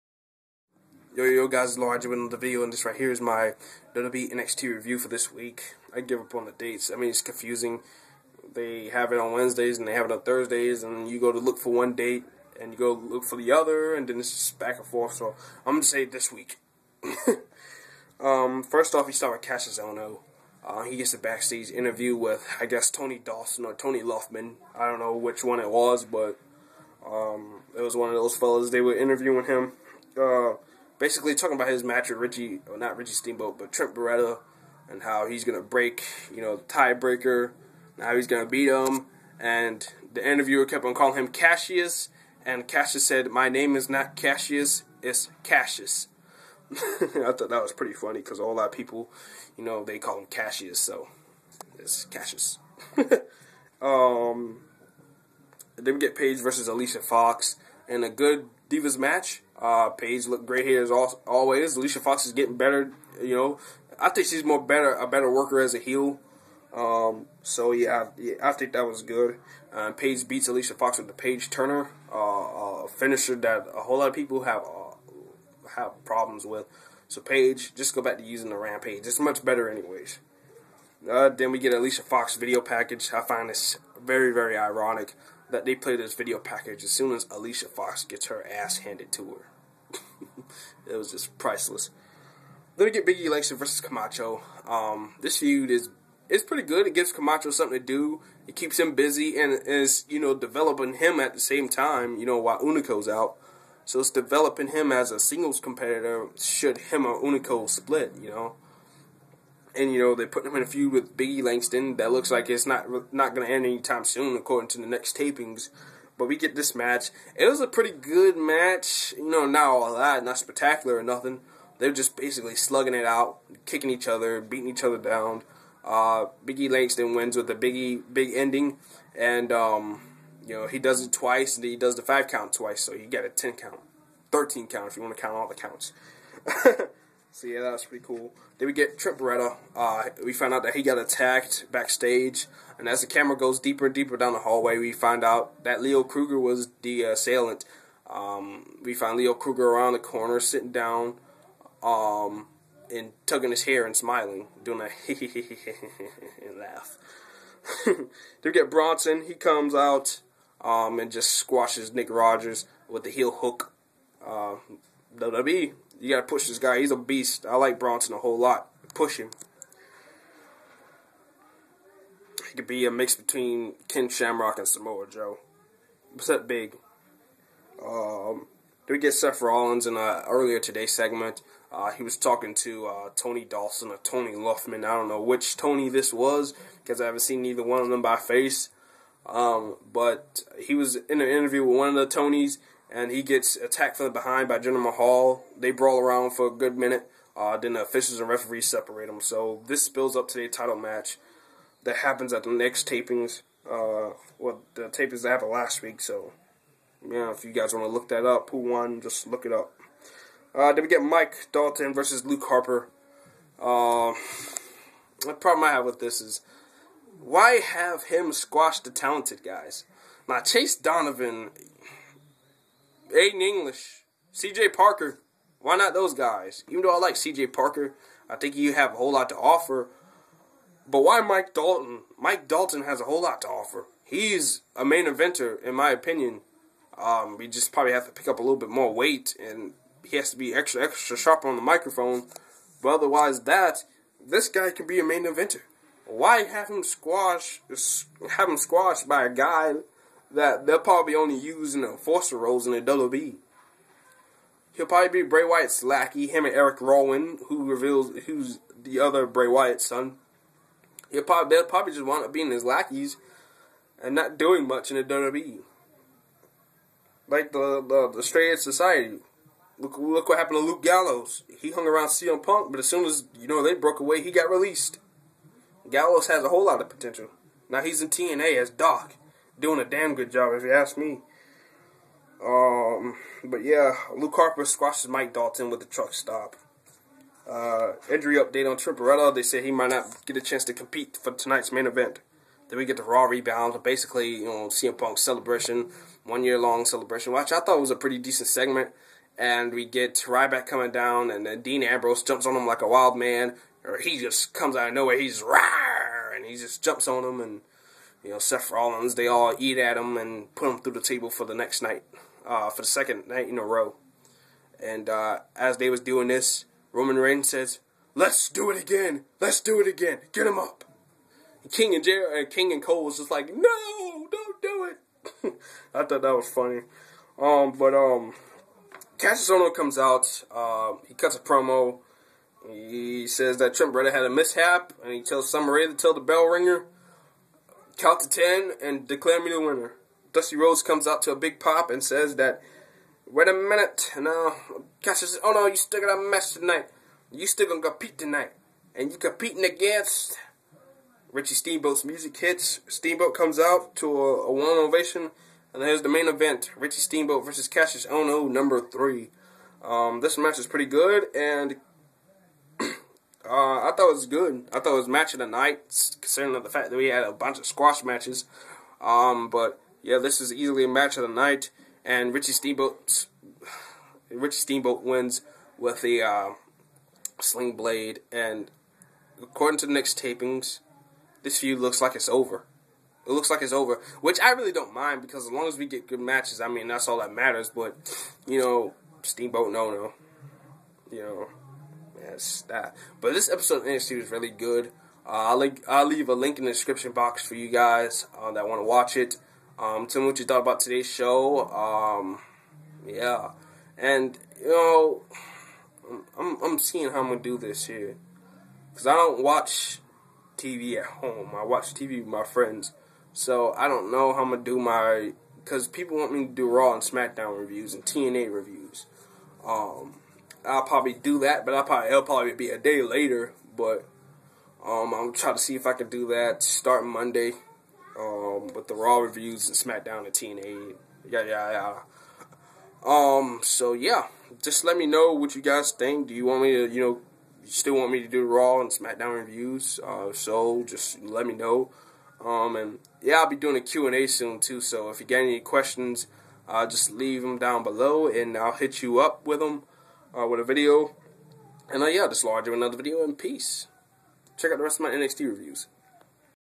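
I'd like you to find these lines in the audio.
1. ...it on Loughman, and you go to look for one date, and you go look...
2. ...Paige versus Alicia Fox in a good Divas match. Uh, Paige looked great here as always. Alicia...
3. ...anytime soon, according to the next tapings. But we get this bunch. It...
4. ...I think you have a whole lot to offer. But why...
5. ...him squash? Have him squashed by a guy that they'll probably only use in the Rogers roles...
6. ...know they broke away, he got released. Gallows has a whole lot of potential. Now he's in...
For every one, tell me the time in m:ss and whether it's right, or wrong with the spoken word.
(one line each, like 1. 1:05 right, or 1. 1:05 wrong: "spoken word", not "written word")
1. 0:10 wrong: "Thursdays", not "Loughman"
2. 0:56 right
3. 1:53 wrong: "match", not "bunch"
4. 3:48 right
5. 4:06 wrong: "Forster", not "Rogers"
6. 4:33 right.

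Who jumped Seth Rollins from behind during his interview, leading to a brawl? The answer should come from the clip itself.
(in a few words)
Jinder Mahal.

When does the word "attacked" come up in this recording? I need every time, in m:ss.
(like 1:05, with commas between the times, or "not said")
2:20, 3:13.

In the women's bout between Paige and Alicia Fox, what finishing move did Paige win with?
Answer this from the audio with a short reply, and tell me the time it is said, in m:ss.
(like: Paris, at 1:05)
Paige Turner, at 1:11.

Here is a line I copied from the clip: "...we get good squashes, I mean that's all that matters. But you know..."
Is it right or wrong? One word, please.
wrong.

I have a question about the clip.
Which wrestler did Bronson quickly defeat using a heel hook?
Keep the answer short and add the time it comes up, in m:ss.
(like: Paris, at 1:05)
Nick Rogers, at 2:41.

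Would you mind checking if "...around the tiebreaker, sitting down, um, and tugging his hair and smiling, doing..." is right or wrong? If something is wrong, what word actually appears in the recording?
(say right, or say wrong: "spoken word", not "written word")
wrong: "corner", not "tiebreaker".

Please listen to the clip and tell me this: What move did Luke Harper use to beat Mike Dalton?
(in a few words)
truck stop.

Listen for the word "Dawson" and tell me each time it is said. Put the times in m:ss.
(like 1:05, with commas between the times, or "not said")
0:23, 3:03.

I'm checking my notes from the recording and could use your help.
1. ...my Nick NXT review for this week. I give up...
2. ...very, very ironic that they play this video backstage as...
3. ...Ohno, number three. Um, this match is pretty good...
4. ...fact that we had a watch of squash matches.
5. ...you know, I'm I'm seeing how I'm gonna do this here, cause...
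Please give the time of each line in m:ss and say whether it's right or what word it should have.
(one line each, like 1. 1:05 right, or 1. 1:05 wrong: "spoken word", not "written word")
1. 0:03 wrong: "WWE", not "Nick"
2. 1:24 wrong: "package", not "backstage"
3. 5:58 right
4. 6:06 wrong: "bunch", not "watch"
5. 6:44 right.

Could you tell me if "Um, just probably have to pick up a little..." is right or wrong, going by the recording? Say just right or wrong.
right.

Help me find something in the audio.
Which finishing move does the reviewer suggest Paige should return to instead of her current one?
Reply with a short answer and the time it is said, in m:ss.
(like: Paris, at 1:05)
Rampage, at 1:18.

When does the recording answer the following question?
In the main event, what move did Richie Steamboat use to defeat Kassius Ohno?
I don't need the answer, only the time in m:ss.
6:17.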